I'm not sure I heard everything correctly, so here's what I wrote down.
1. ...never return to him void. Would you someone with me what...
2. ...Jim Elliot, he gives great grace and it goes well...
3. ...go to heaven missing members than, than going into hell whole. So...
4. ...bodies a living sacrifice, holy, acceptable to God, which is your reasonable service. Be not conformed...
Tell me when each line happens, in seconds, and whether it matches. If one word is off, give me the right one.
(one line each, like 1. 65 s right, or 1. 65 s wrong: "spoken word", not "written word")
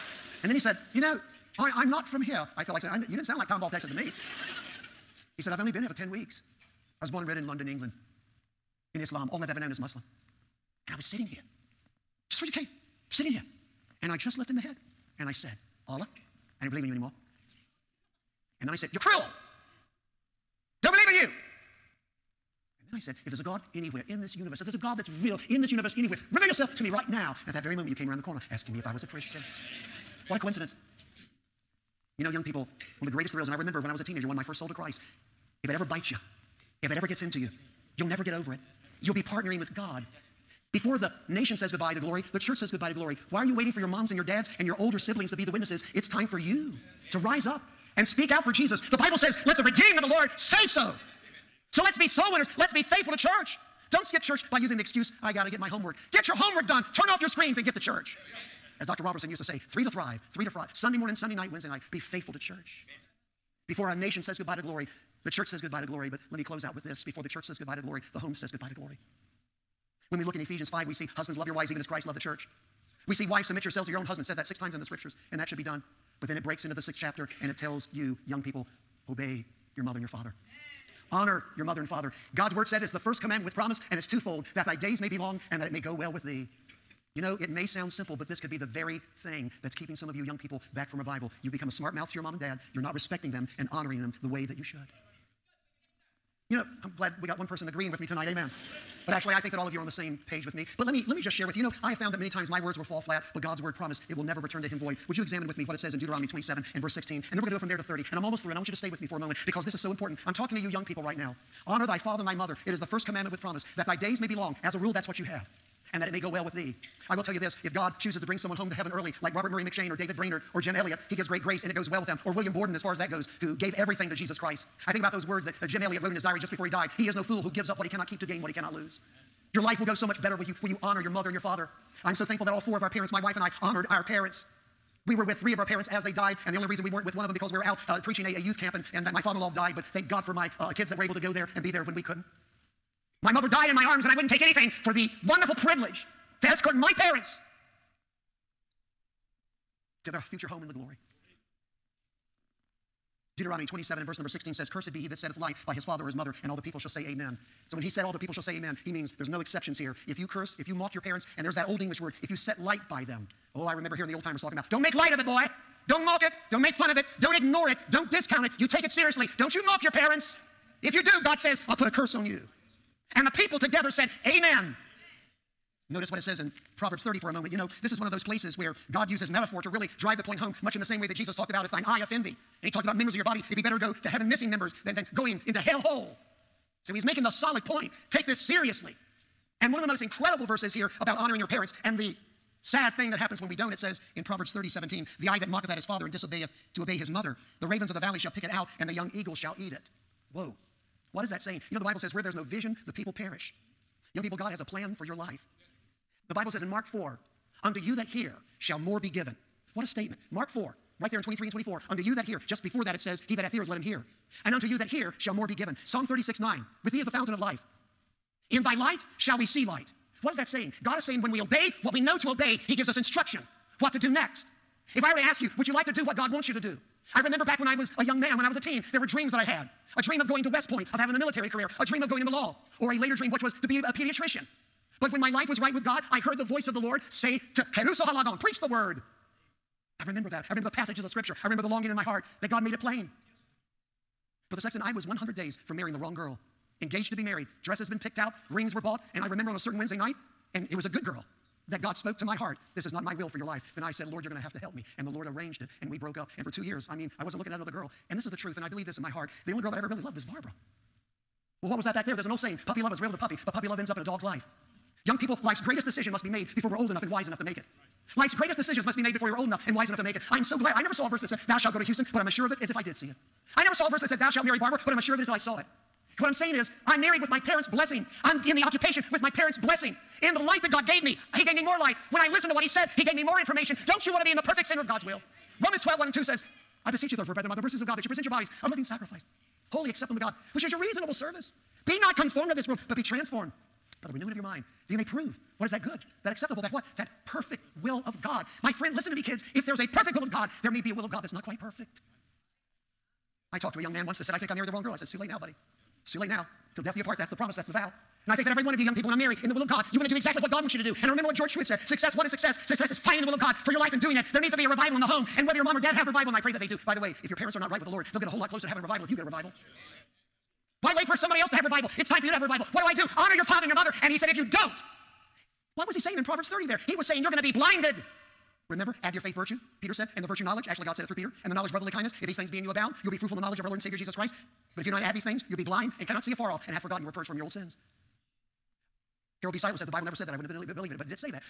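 1. 104 s wrong: "examine", not "someone"
2. 120 s right
3. 183 s right
4. 288 s right.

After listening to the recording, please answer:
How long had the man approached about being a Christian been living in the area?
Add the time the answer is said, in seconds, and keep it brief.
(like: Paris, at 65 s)
10 weeks, at 5 s.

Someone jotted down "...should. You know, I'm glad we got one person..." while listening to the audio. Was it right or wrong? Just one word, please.
right.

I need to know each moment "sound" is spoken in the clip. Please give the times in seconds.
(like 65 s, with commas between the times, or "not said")
3 s, 87 s.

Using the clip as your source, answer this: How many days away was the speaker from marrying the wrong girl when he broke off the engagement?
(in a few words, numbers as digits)
100.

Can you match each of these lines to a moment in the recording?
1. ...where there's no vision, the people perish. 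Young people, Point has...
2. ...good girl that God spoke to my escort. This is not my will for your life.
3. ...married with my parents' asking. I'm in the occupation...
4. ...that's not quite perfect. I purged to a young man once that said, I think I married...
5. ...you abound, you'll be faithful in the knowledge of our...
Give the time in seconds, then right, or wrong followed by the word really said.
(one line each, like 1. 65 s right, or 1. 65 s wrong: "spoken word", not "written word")
1. 202 s wrong: "God", not "Point"
2. 250 s wrong: "heart", not "escort"
3. 277 s wrong: "blessing", not "asking"
4. 301 s wrong: "talked", not "purged"
5. 332 s wrong: "fruitful", not "faithful".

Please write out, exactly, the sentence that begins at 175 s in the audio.
Notice what it says in Proverbs 30 for a moment.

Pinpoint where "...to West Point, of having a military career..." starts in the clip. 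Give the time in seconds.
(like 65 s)
230 s.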